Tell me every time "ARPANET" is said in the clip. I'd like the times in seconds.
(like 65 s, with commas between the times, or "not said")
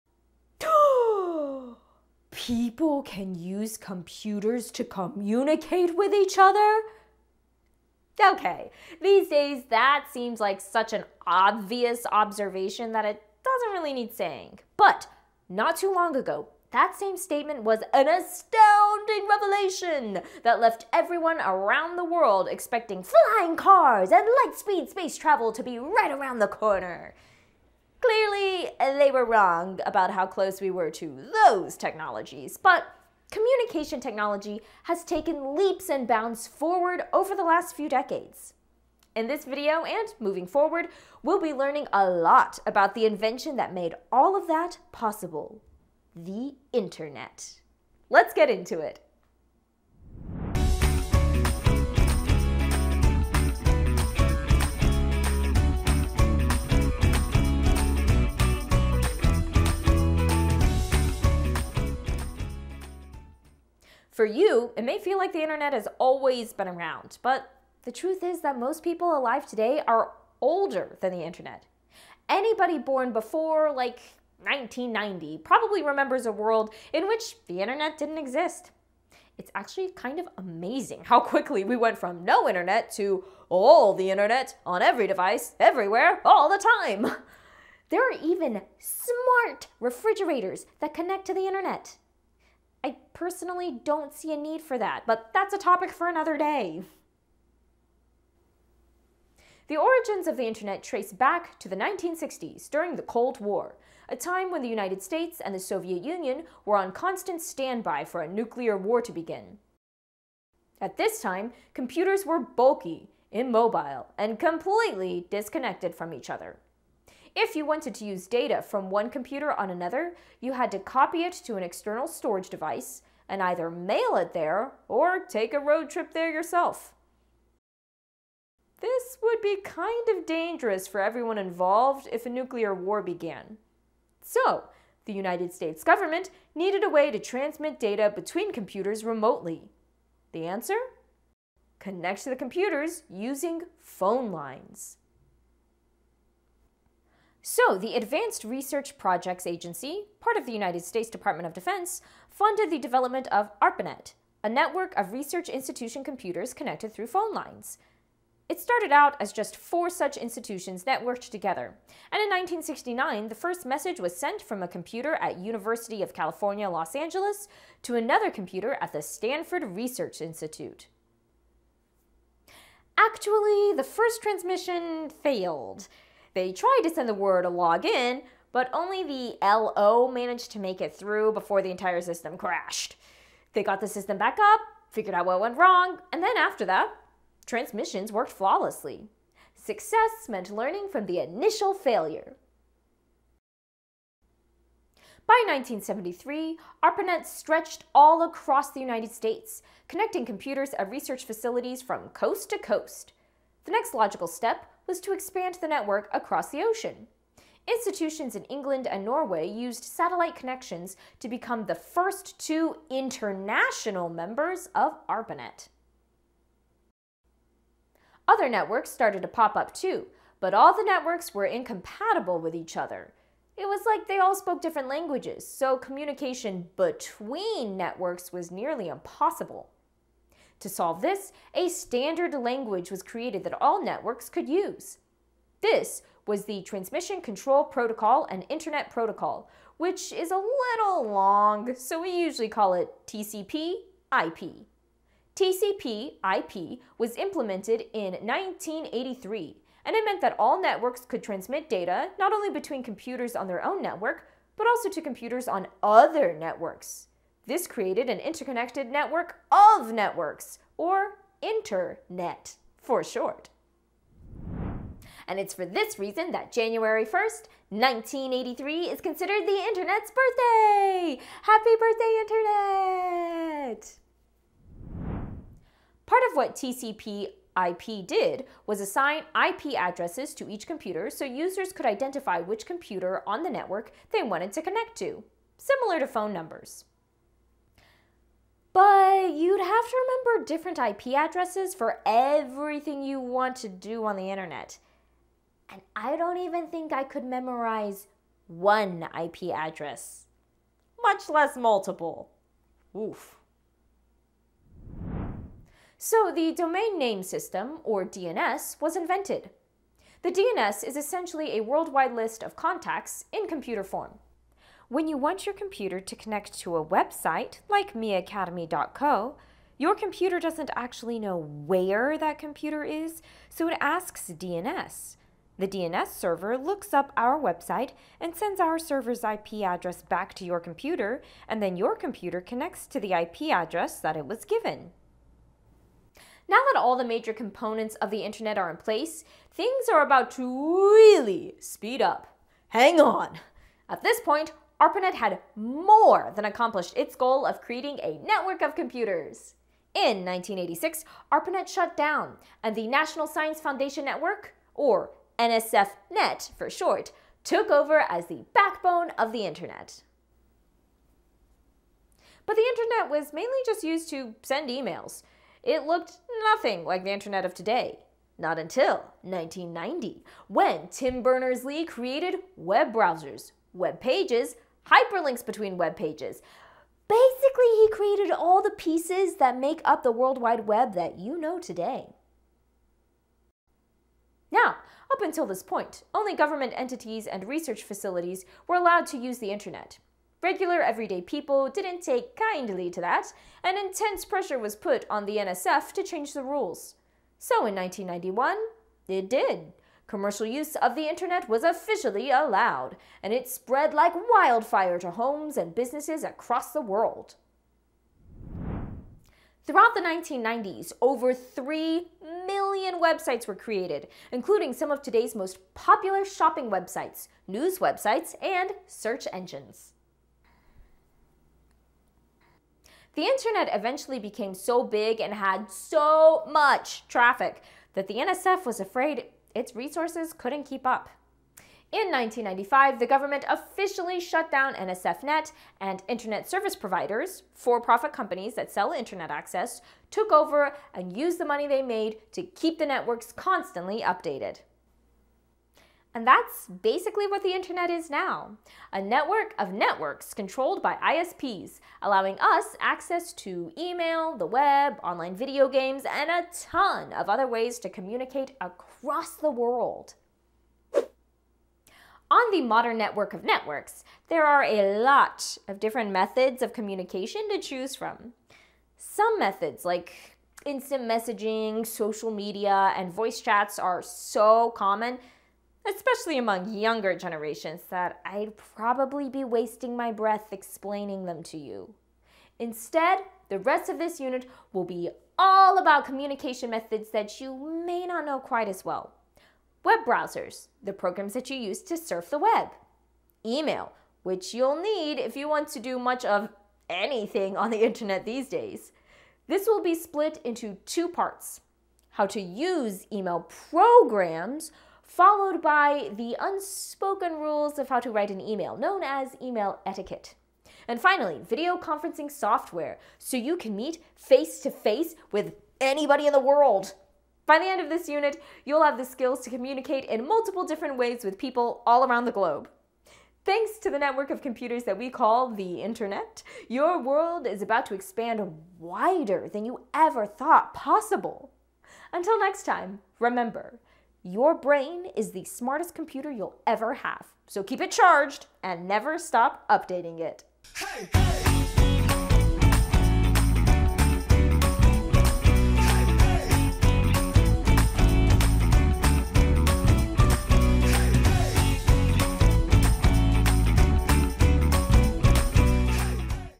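153 s, 196 s, 215 s, 344 s, 351 s.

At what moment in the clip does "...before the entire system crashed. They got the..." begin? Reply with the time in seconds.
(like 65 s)
181 s.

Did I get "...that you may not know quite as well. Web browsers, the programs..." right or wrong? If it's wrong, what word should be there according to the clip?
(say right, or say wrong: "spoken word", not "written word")
right.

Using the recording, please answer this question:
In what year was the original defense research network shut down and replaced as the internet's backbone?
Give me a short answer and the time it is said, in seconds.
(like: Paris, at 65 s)
1986, at 350 s.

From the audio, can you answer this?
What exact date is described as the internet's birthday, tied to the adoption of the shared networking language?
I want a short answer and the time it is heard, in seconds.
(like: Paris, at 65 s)
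January 1st, 1983, at 266 s.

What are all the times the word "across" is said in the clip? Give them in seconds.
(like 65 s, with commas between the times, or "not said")
198 s, 206 s, 406 s, 458 s.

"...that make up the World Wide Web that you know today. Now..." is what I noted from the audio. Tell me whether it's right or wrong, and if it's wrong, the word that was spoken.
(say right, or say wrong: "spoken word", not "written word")
right.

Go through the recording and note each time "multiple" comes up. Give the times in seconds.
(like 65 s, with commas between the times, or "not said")
301 s, 520 s.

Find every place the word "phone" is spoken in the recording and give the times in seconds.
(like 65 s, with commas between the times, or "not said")
143 s, 157 s, 286 s.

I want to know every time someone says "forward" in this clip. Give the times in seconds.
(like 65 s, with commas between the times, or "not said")
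36 s, 40 s.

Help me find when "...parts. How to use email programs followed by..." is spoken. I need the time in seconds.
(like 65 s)
501 s.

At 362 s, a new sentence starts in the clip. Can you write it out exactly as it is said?
But the internet was mainly just used to send emails.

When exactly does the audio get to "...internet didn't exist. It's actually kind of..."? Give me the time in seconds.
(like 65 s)
77 s.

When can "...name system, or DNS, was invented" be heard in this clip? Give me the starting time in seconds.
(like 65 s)
306 s.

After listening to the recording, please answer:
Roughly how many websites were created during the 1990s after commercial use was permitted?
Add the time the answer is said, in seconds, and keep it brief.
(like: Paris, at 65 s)
over 3 million, at 410 s.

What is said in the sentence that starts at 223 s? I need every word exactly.
It was like they all spoke different languages, so communication between networks was nearly impossible.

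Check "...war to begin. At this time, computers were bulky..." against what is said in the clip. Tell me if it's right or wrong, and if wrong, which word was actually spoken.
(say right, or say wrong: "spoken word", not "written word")
right.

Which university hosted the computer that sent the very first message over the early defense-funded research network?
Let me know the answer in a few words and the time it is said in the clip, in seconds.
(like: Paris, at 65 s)
University of California, Los Angeles, at 165 s.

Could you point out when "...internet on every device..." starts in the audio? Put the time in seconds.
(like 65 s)
84 s.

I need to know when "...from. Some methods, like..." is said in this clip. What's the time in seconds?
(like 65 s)
467 s.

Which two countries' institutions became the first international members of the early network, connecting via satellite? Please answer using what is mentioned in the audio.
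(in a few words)
England and Norway.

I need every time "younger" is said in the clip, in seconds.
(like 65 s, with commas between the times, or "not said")
476 s.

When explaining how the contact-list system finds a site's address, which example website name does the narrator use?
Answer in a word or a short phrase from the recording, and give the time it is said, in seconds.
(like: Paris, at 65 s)
miacademy.co, at 317 s.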